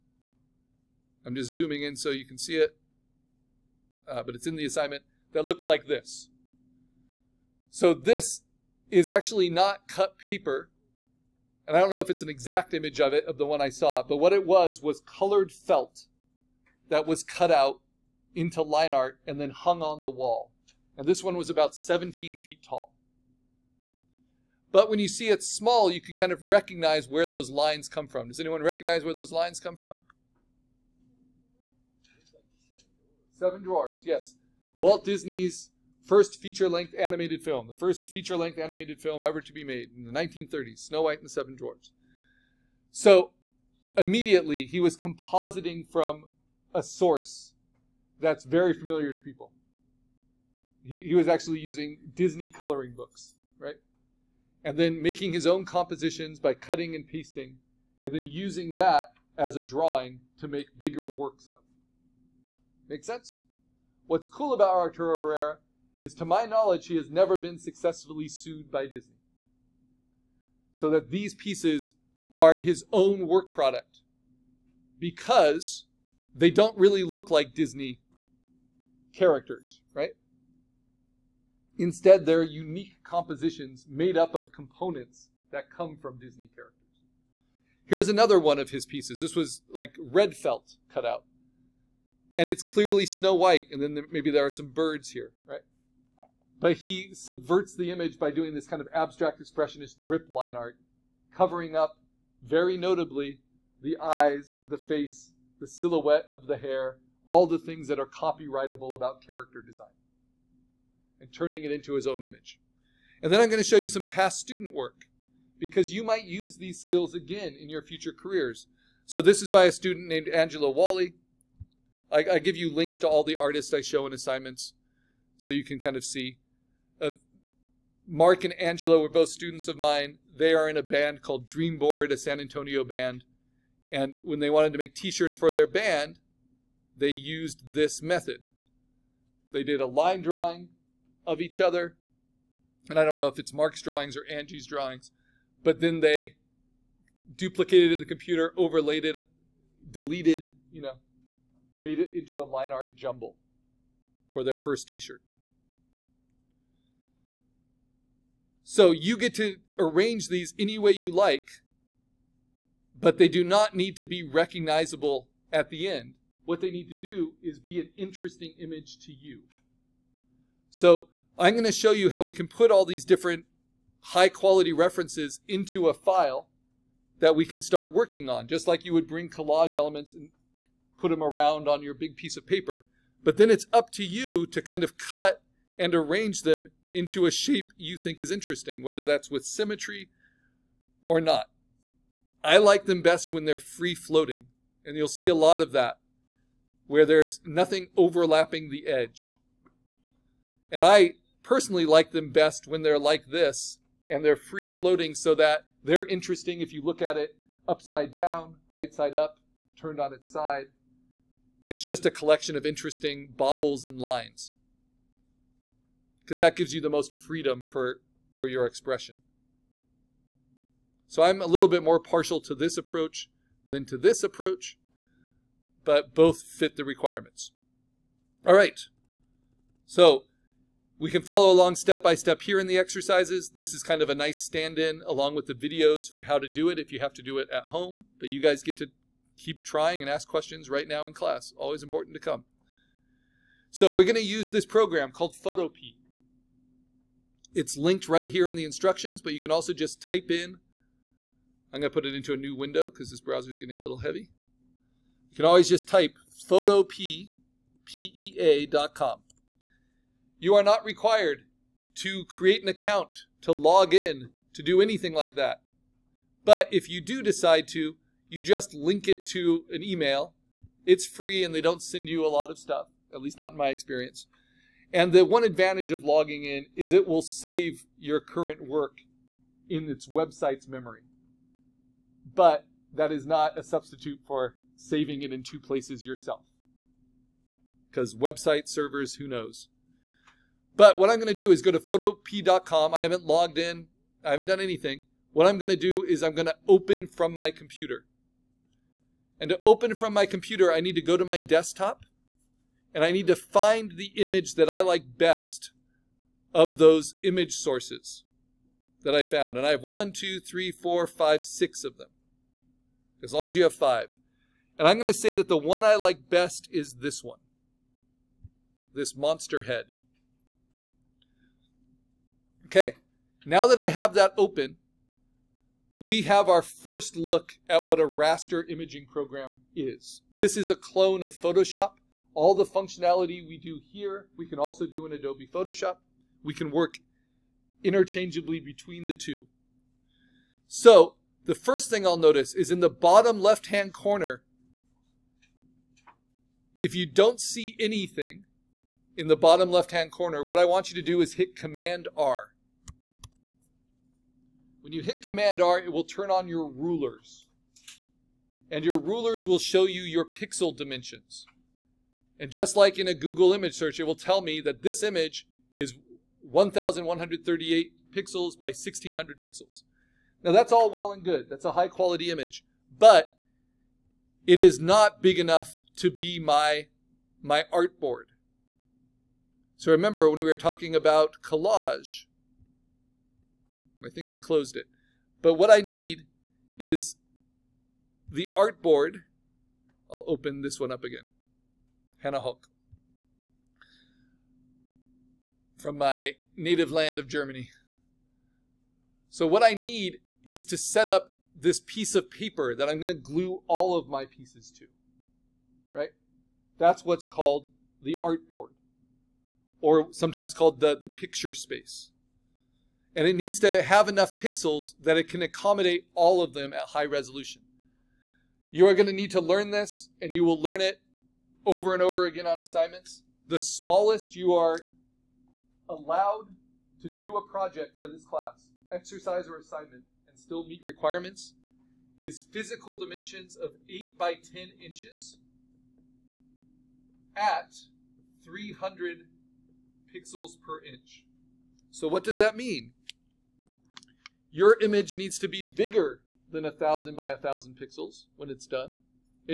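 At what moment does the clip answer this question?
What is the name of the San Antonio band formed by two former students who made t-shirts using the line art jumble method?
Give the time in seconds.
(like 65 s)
131 s.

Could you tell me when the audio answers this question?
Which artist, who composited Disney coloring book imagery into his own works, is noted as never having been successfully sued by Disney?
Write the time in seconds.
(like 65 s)
64 s.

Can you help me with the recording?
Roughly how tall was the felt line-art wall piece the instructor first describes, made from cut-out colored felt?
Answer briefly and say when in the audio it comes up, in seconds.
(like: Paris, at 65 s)
17 feet, at 21 s.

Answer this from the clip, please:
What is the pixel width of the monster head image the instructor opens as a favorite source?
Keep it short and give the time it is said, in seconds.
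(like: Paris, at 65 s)
1,138 pixels, at 366 s.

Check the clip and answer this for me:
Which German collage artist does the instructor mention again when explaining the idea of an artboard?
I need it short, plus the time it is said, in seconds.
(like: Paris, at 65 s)
Hannah Höch, at 392 s.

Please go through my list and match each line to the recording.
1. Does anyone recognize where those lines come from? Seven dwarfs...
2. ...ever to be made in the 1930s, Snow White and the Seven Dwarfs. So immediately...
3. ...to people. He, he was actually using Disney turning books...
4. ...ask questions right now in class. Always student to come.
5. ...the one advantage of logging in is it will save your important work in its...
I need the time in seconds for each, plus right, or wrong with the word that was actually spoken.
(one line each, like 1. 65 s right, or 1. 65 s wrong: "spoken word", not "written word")
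1. 28 s right
2. 39 s right
3. 49 s wrong: "coloring", not "turning"
4. 240 s wrong: "important", not "student"
5. 275 s wrong: "current", not "important".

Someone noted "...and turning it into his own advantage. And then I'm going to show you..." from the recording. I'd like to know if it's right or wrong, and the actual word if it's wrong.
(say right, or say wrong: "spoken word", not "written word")
wrong: "image", not "advantage".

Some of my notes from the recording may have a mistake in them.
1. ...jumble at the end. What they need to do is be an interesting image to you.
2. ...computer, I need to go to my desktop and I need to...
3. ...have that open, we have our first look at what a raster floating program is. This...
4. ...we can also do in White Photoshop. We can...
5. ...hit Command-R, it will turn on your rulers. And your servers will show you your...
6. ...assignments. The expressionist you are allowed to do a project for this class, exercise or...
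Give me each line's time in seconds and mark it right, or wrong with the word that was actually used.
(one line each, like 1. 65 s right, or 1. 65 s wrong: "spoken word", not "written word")
1. 164 s wrong: "recognizable", not "jumble"
2. 300 s right
3. 323 s wrong: "imaging", not "floating"
4. 334 s wrong: "Adobe", not "White"
5. 355 s wrong: "rulers", not "servers"
6. 422 s wrong: "smallest", not "expressionist".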